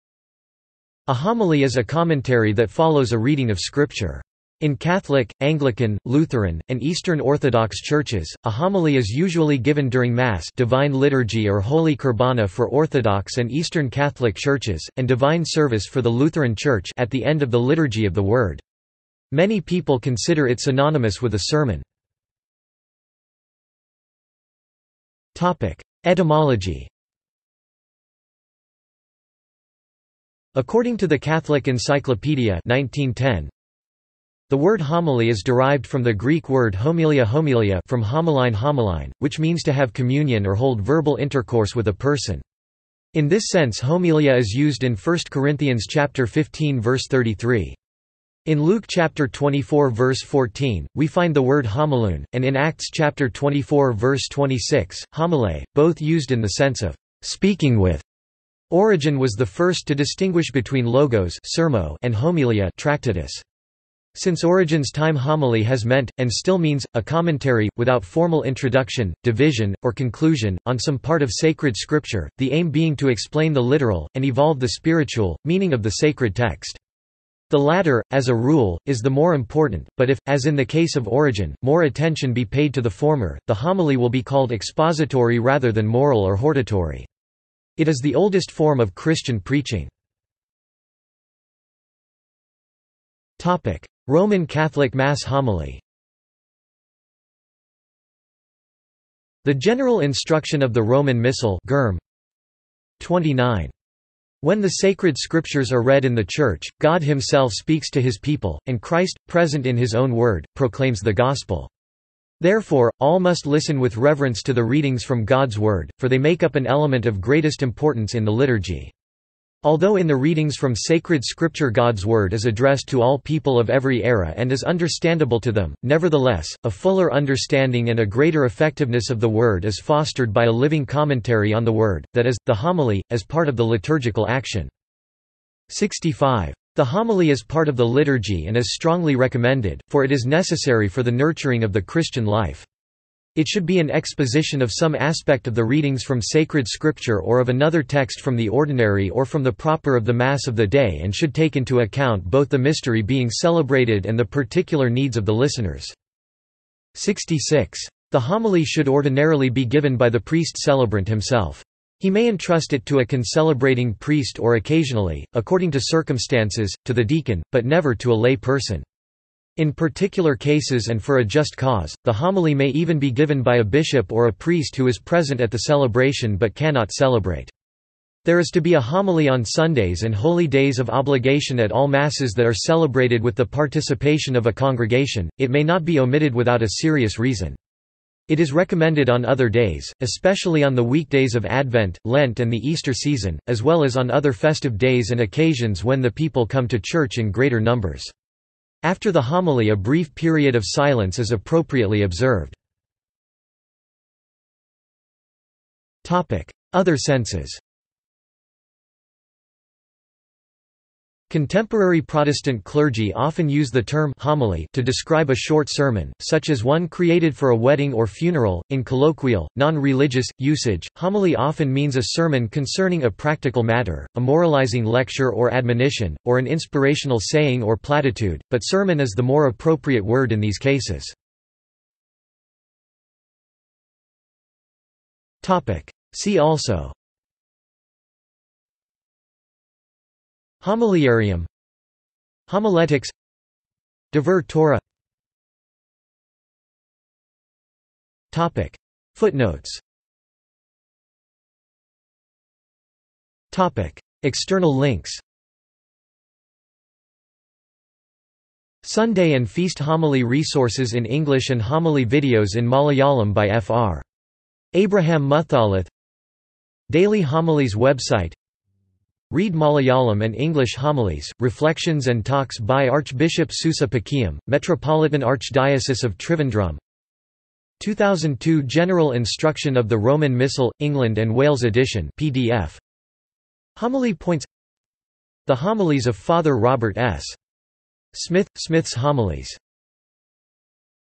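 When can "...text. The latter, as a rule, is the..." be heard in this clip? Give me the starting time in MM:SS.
01:16.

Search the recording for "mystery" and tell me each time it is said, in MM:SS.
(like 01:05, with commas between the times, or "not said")
02:32.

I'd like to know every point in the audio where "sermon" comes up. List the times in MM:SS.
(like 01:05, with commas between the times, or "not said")
00:21, 03:35, 03:42, 03:48.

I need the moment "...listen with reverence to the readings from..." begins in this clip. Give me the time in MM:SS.
01:53.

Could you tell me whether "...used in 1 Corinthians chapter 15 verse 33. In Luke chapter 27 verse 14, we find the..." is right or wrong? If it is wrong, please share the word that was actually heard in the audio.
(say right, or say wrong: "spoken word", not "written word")
wrong: "24", not "27".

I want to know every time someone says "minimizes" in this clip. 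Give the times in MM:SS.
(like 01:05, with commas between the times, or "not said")
not said.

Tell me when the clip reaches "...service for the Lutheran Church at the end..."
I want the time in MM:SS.
00:15.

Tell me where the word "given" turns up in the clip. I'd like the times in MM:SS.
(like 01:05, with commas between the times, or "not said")
00:09, 02:39, 02:53.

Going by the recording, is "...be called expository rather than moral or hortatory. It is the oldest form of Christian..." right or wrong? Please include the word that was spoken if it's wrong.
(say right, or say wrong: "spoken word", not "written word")
right.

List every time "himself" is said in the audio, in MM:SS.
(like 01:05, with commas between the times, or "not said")
01:47, 02:41.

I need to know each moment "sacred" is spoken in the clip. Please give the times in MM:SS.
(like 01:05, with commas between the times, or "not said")
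01:11, 01:15, 01:44, 02:00, 02:26.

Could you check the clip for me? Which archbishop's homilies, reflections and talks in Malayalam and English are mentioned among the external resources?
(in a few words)
Archbishop Soosa Pakiam.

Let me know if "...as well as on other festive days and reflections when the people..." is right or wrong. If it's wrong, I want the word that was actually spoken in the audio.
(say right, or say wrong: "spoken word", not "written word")
wrong: "occasions", not "reflections".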